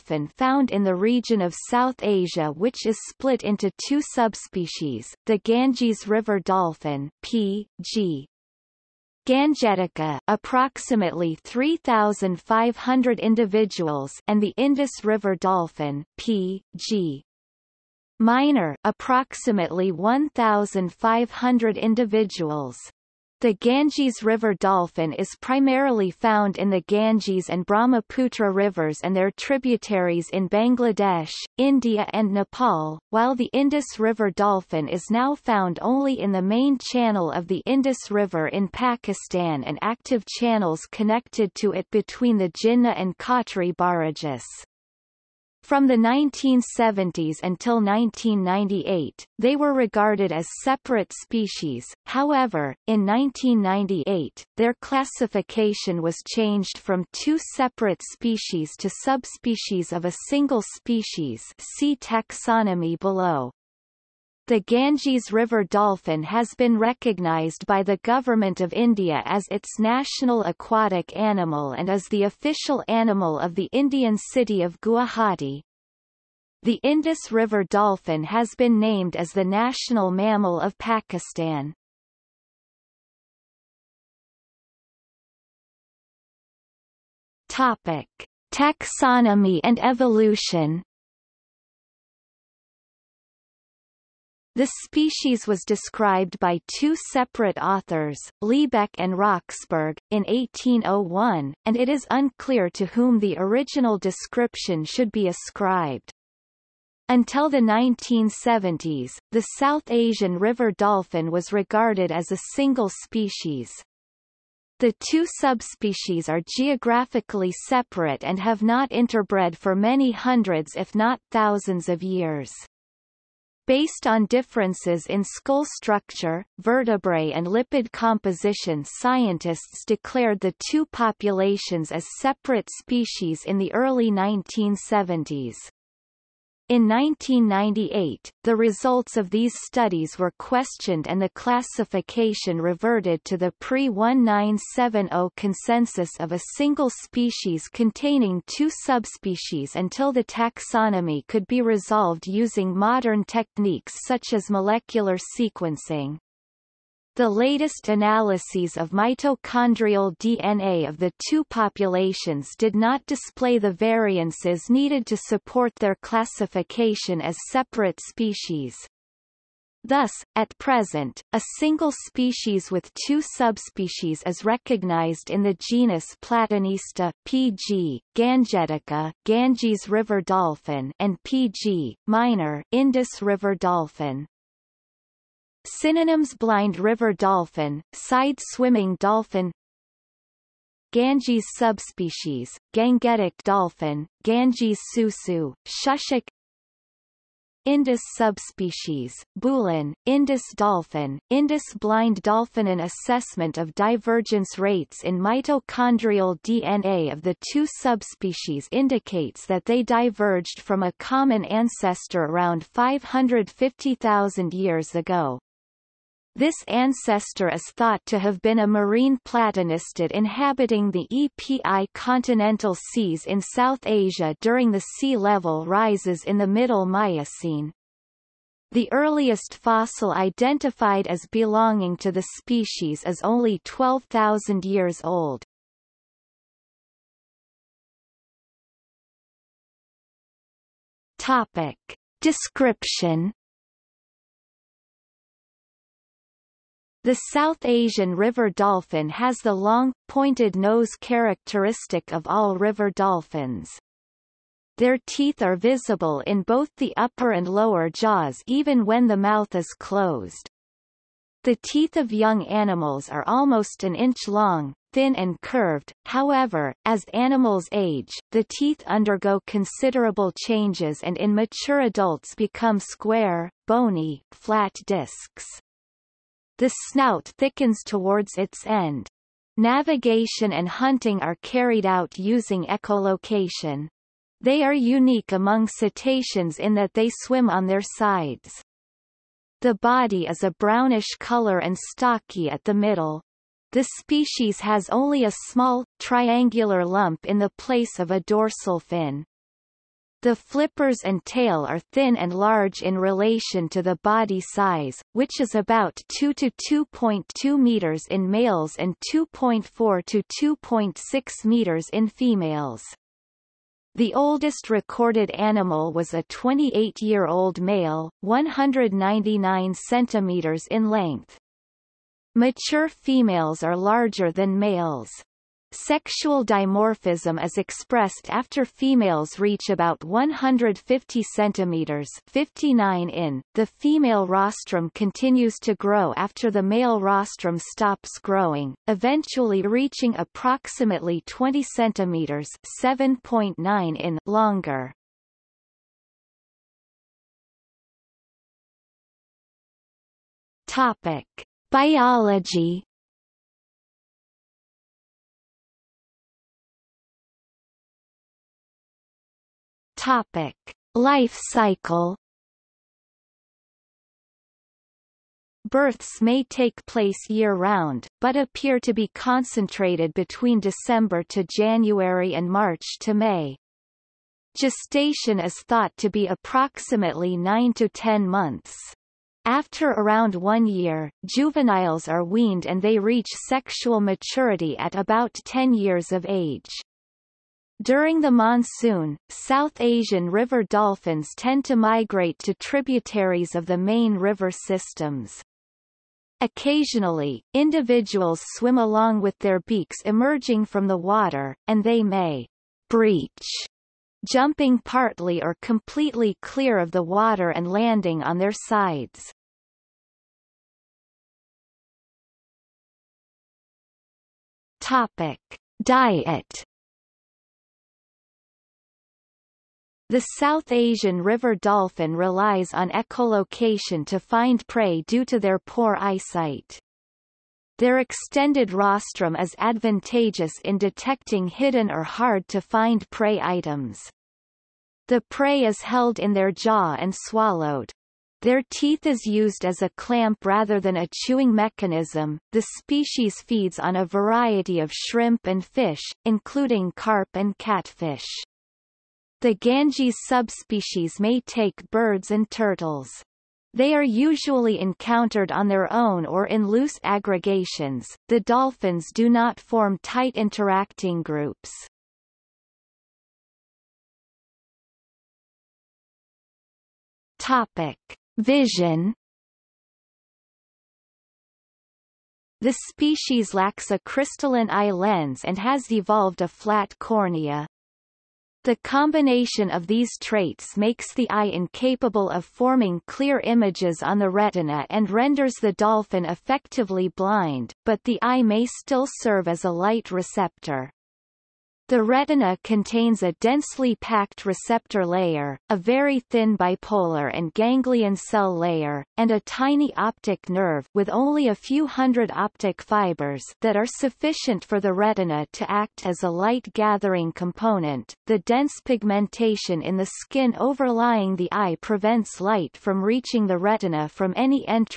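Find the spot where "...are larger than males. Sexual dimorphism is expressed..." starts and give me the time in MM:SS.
05:23.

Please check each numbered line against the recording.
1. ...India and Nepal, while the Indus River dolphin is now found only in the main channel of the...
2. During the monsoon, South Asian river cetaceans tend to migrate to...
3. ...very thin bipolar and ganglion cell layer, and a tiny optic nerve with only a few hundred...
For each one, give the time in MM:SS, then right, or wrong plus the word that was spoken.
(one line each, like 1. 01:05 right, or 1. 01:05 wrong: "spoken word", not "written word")
1. 00:31 right
2. 06:27 wrong: "dolphins", not "cetaceans"
3. 08:15 right.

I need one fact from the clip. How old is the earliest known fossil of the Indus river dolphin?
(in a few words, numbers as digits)
12,000 years.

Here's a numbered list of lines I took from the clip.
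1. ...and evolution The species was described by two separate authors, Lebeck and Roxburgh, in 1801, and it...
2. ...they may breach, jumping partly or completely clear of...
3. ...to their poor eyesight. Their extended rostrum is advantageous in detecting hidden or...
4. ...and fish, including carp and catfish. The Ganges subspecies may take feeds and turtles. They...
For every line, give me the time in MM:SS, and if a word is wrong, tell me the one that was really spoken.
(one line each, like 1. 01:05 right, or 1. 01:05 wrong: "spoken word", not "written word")
1. 01:29 right
2. 06:41 right
3. 07:05 right
4. 07:25 wrong: "birds", not "feeds".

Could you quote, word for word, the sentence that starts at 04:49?
The body is a brownish color and stocky at the middle.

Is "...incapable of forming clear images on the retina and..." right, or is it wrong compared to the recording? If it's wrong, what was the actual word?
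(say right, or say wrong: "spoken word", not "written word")
right.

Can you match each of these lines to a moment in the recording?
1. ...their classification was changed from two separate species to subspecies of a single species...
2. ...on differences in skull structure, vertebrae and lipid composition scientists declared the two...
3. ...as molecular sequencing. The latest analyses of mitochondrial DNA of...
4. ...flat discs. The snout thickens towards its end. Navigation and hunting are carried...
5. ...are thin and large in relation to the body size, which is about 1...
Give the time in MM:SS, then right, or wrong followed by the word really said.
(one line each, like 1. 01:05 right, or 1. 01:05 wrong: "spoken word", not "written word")
1. 00:54 right
2. 02:04 right
3. 02:34 right
4. 04:34 right
5. 05:01 wrong: "2", not "1".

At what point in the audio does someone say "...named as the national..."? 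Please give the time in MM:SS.
01:18.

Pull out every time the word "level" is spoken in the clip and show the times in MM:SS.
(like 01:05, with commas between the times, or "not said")
03:45.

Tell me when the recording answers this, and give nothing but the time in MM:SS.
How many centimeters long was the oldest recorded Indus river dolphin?
05:18.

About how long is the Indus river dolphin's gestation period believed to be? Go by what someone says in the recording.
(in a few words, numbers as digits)
9 to 10 months.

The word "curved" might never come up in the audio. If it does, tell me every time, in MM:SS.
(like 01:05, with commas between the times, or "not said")
04:25.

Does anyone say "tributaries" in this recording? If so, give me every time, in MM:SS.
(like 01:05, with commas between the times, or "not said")
00:29, 06:32.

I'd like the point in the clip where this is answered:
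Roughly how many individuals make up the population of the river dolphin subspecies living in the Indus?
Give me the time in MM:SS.
00:19.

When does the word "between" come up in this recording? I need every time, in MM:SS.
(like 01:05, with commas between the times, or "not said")
00:41, 06:10.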